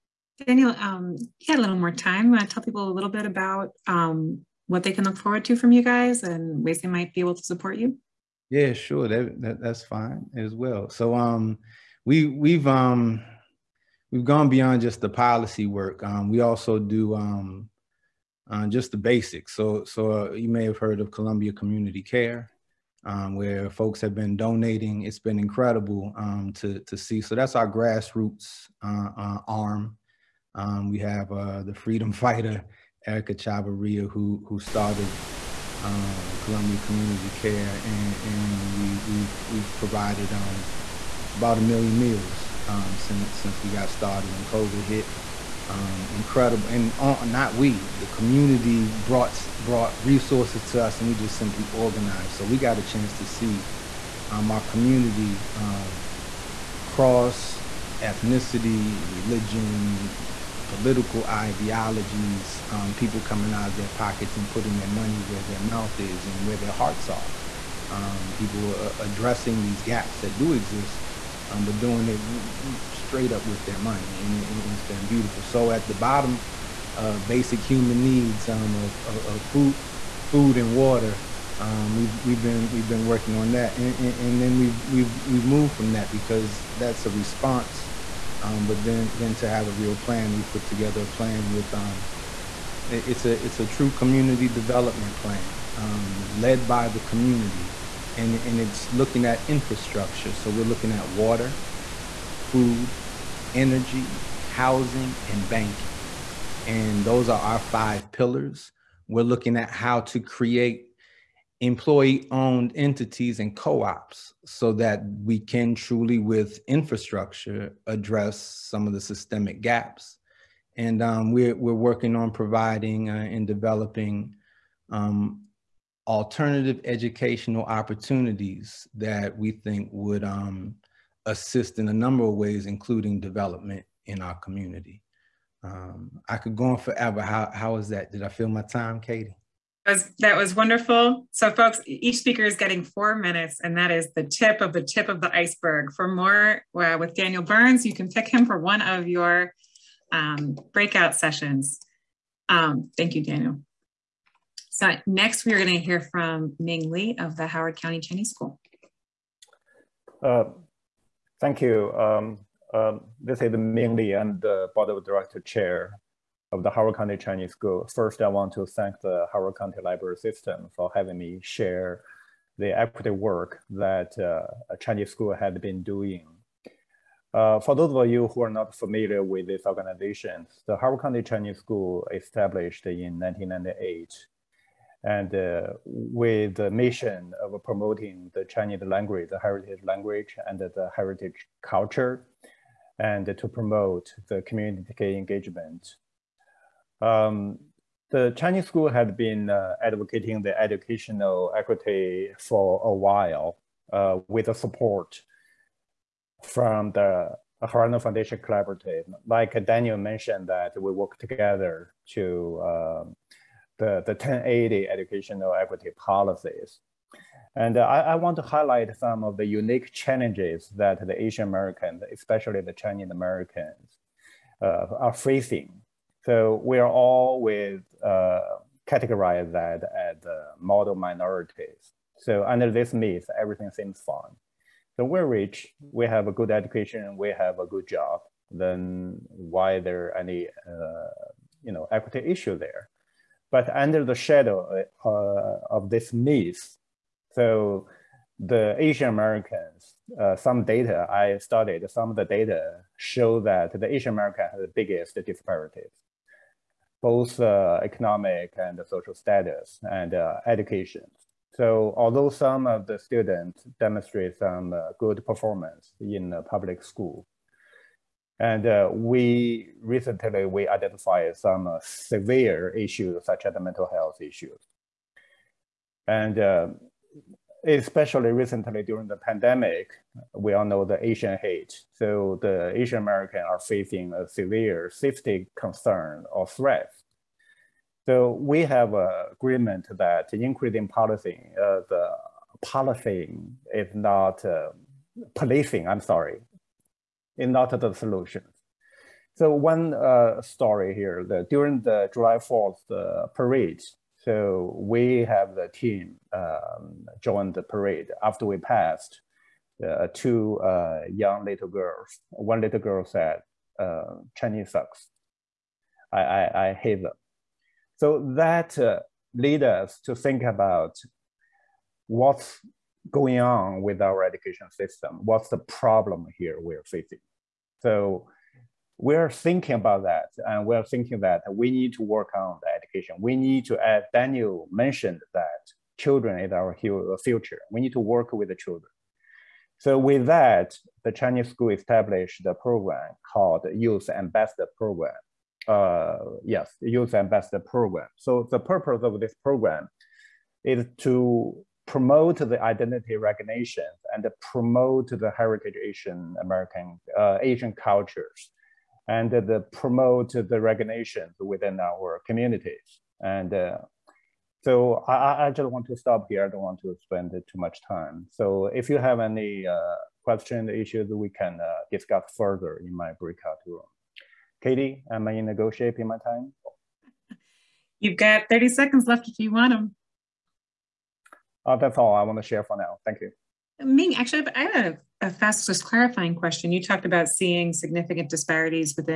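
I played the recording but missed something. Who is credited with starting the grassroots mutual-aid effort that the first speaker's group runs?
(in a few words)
Erica Chavarria.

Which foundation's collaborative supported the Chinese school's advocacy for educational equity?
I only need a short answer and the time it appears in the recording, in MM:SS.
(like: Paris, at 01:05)
Horizon Foundation, at 03:27.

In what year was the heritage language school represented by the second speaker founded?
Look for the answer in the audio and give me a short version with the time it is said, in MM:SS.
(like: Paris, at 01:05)
1998, at 03:03.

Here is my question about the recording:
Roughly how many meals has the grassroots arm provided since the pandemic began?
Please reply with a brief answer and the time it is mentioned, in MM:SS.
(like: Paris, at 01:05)
about a million, at 00:41.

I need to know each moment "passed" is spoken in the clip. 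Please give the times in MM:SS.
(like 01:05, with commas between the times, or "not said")
05:08.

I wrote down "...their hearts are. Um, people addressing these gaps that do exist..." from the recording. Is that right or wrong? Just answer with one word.
right.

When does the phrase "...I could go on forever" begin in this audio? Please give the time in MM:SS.
02:16.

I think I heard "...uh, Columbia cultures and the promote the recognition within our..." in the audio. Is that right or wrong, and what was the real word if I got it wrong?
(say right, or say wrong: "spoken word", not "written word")
wrong: "Asian", not "Columbia".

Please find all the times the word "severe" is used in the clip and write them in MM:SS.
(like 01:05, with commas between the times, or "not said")
04:31, 04:44.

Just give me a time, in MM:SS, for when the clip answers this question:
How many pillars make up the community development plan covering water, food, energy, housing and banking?
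01:47.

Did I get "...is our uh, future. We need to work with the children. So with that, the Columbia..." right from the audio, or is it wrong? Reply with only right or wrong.
wrong.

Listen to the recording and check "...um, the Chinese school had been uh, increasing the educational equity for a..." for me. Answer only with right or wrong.
wrong.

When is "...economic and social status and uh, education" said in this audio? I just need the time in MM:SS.
04:17.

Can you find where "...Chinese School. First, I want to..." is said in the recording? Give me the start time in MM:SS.
02:47.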